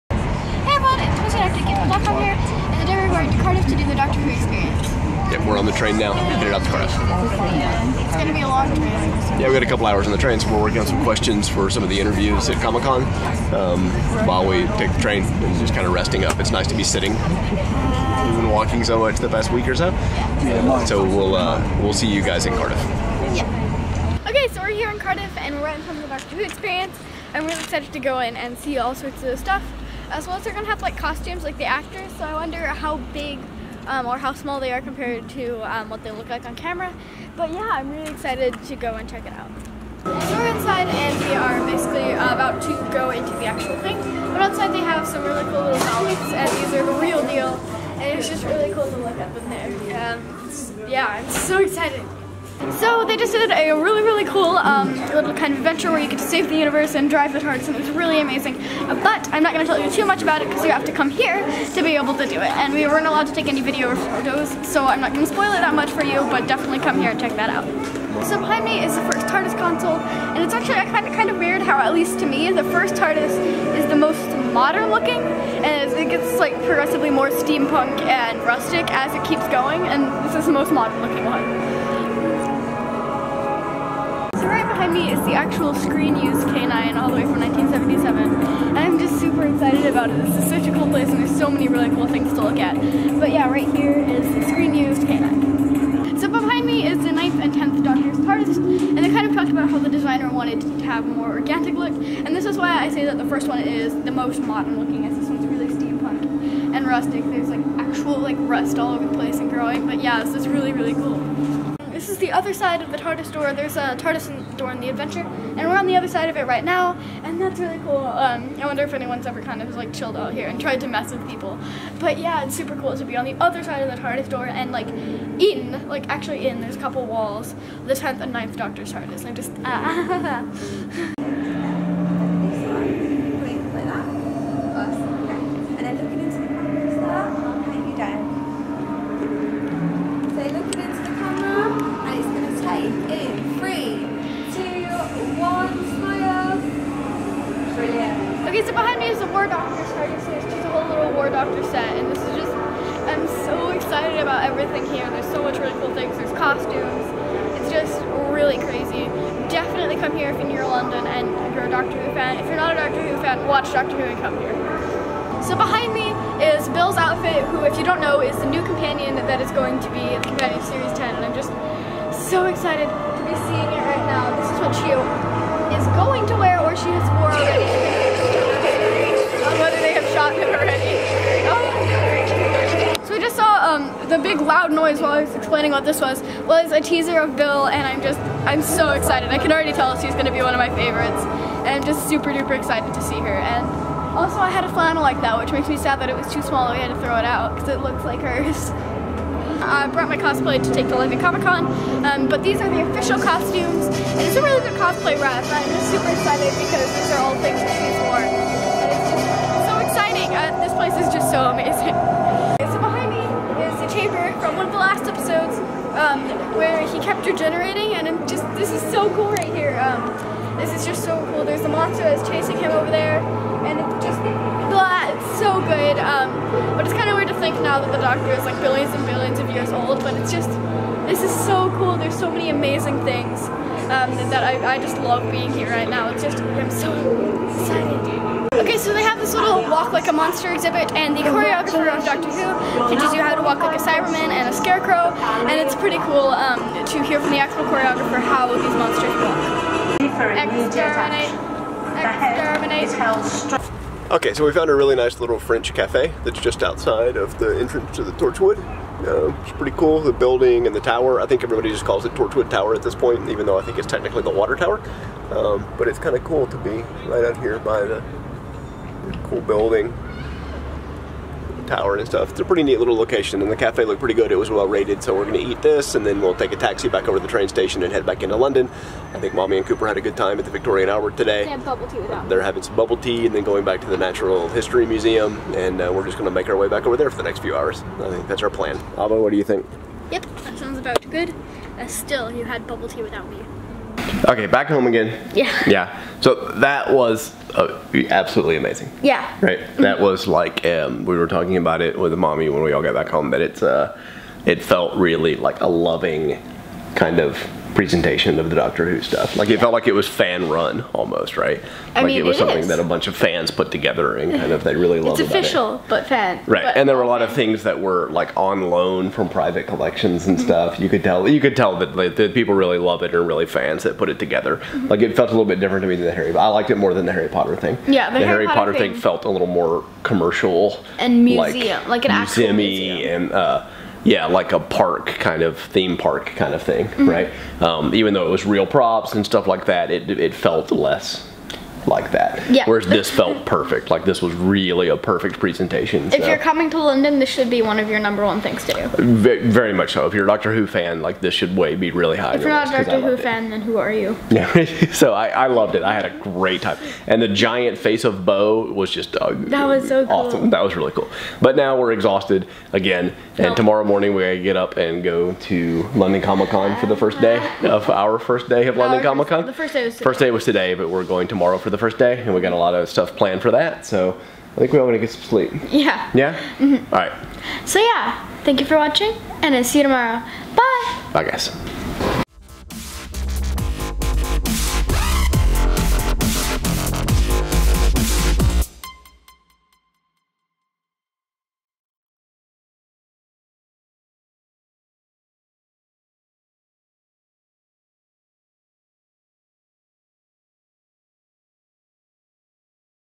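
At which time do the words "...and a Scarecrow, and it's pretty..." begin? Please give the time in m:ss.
4:04.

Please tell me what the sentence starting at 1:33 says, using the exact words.
But yeah, right here is the screen used K-9.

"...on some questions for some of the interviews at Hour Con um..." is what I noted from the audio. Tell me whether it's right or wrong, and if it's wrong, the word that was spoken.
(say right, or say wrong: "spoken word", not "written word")
wrong: "Comic", not "Hour".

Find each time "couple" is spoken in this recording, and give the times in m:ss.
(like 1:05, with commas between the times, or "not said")
0:09, 2:06.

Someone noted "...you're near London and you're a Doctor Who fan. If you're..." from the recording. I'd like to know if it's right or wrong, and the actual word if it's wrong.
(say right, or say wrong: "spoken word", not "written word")
right.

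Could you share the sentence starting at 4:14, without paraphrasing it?
Okay, so we found a really nice little French cafe that's just outside of the entrance to the Torchwood.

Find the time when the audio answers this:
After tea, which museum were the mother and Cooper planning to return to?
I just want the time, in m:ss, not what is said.
4:43.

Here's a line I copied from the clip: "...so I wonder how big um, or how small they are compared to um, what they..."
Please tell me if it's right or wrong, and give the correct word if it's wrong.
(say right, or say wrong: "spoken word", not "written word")
right.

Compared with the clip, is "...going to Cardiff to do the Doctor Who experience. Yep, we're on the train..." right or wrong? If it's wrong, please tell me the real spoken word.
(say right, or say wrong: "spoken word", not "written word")
right.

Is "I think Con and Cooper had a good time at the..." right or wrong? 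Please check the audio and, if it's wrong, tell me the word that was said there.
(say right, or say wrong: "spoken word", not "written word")
wrong: "Mommy", not "Con".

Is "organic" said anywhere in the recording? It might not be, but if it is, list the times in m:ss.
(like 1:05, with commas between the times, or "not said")
1:41.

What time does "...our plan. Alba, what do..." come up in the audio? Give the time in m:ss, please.
4:48.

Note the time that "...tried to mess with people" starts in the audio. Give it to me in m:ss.
2:00.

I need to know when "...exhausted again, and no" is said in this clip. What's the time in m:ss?
6:01.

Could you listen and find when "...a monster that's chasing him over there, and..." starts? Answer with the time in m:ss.
3:41.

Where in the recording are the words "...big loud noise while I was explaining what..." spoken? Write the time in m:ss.
3:04.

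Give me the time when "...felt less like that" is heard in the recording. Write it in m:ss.
5:40.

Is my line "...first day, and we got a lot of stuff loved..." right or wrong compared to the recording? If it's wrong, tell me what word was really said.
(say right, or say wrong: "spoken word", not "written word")
wrong: "planned", not "loved".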